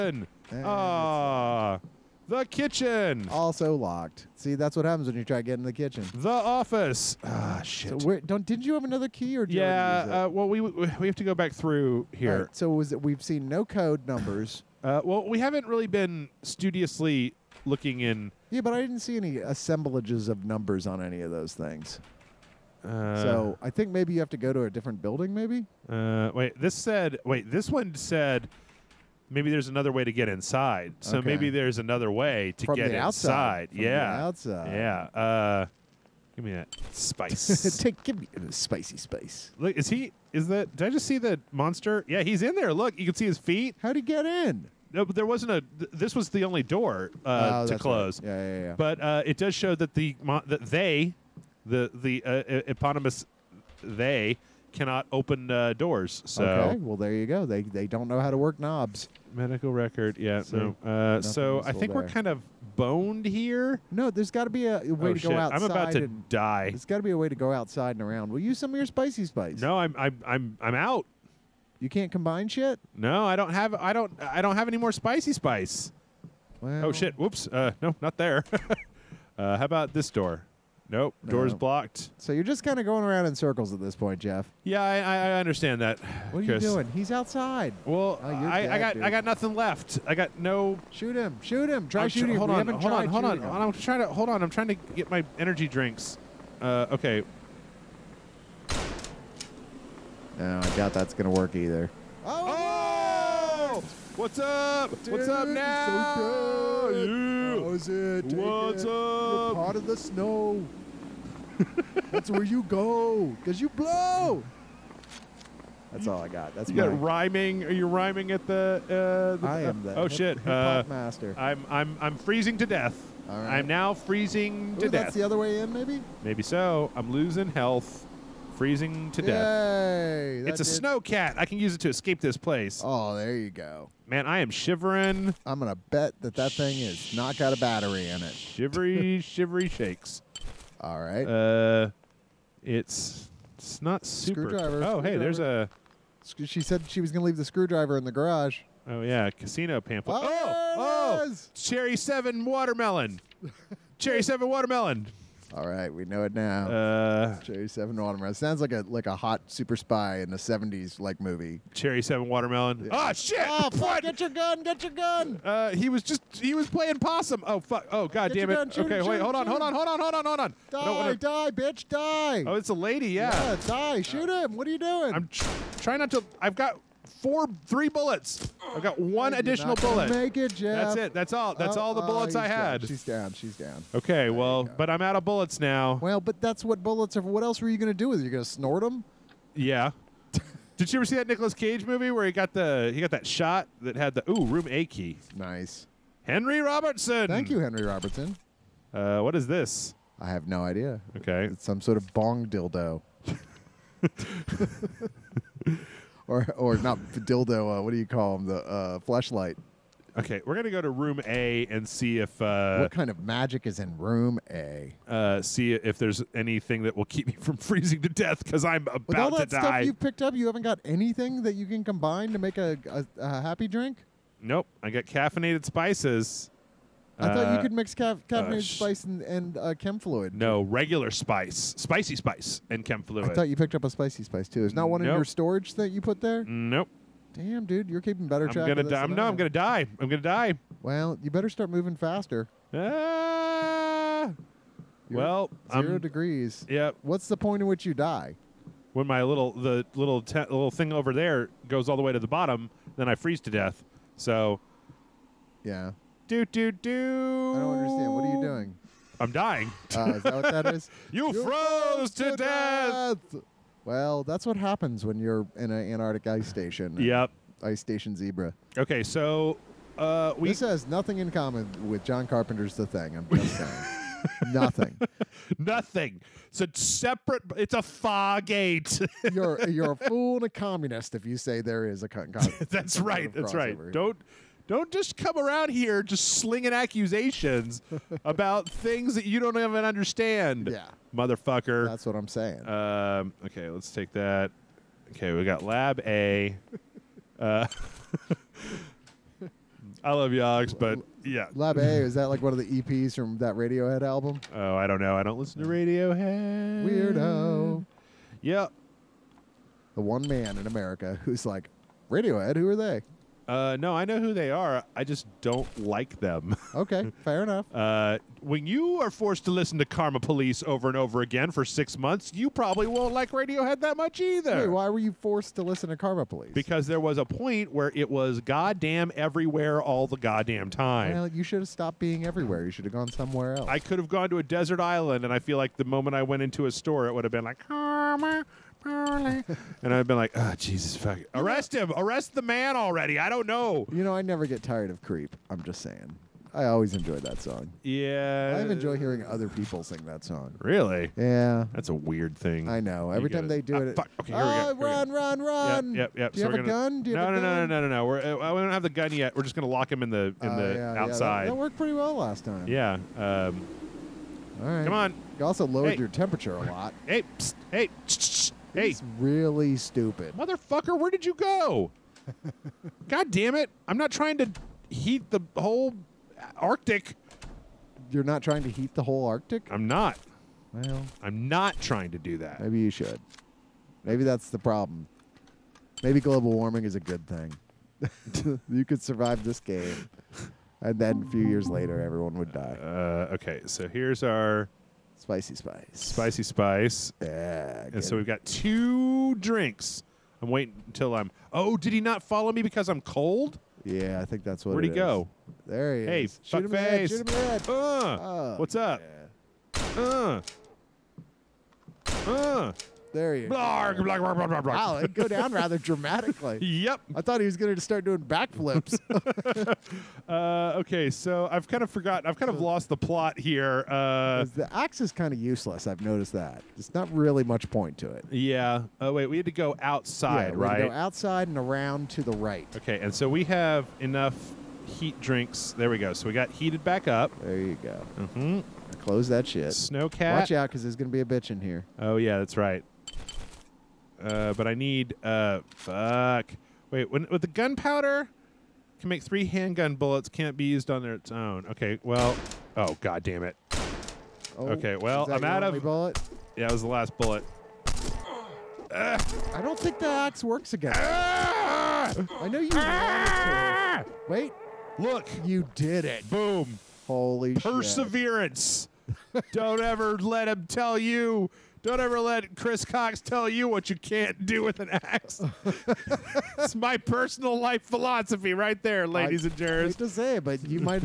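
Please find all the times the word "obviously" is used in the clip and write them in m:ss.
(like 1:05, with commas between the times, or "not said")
not said.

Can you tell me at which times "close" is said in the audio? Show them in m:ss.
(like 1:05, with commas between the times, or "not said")
0:47, 7:18.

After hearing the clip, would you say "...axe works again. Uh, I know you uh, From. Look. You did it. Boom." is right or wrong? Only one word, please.
wrong.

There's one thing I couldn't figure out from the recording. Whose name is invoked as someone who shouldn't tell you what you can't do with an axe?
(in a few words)
Chris Cox.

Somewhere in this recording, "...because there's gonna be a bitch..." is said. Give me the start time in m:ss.
7:20.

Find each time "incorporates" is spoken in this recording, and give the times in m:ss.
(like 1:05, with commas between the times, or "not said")
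not said.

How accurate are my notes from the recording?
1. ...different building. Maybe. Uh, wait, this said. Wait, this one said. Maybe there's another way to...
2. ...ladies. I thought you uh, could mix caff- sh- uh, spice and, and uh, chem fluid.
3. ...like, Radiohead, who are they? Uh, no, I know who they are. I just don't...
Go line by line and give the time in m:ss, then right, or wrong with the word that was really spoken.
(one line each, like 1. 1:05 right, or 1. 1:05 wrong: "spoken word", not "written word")
1. 0:24 right
2. 3:45 wrong: "spices", not "ladies"
3. 5:11 right.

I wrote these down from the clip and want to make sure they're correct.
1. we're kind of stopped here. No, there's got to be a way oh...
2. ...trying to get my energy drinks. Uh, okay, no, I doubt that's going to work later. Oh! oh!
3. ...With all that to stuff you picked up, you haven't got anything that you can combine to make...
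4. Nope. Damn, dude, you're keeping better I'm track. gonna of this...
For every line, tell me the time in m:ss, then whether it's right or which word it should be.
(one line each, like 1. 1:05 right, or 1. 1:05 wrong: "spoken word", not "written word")
1. 1:02 wrong: "boned", not "stopped"
2. 1:34 wrong: "either", not "later"
3. 3:39 right
4. 3:56 right.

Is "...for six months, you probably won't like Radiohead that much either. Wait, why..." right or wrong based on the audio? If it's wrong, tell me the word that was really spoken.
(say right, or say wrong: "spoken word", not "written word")
right.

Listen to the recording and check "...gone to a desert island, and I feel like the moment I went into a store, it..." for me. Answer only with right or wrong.
right.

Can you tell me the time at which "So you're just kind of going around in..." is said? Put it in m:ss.
1:22.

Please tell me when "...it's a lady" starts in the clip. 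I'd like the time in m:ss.
2:52.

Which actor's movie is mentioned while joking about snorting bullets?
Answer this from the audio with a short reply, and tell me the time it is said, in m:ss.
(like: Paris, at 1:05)
Nicolas Cage, at 3:11.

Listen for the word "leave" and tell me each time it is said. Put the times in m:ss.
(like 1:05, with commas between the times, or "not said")
2:27.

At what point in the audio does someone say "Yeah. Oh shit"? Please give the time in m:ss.
2:42.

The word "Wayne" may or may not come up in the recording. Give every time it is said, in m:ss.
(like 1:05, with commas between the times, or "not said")
not said.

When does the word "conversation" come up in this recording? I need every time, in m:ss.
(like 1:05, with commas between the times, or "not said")
not said.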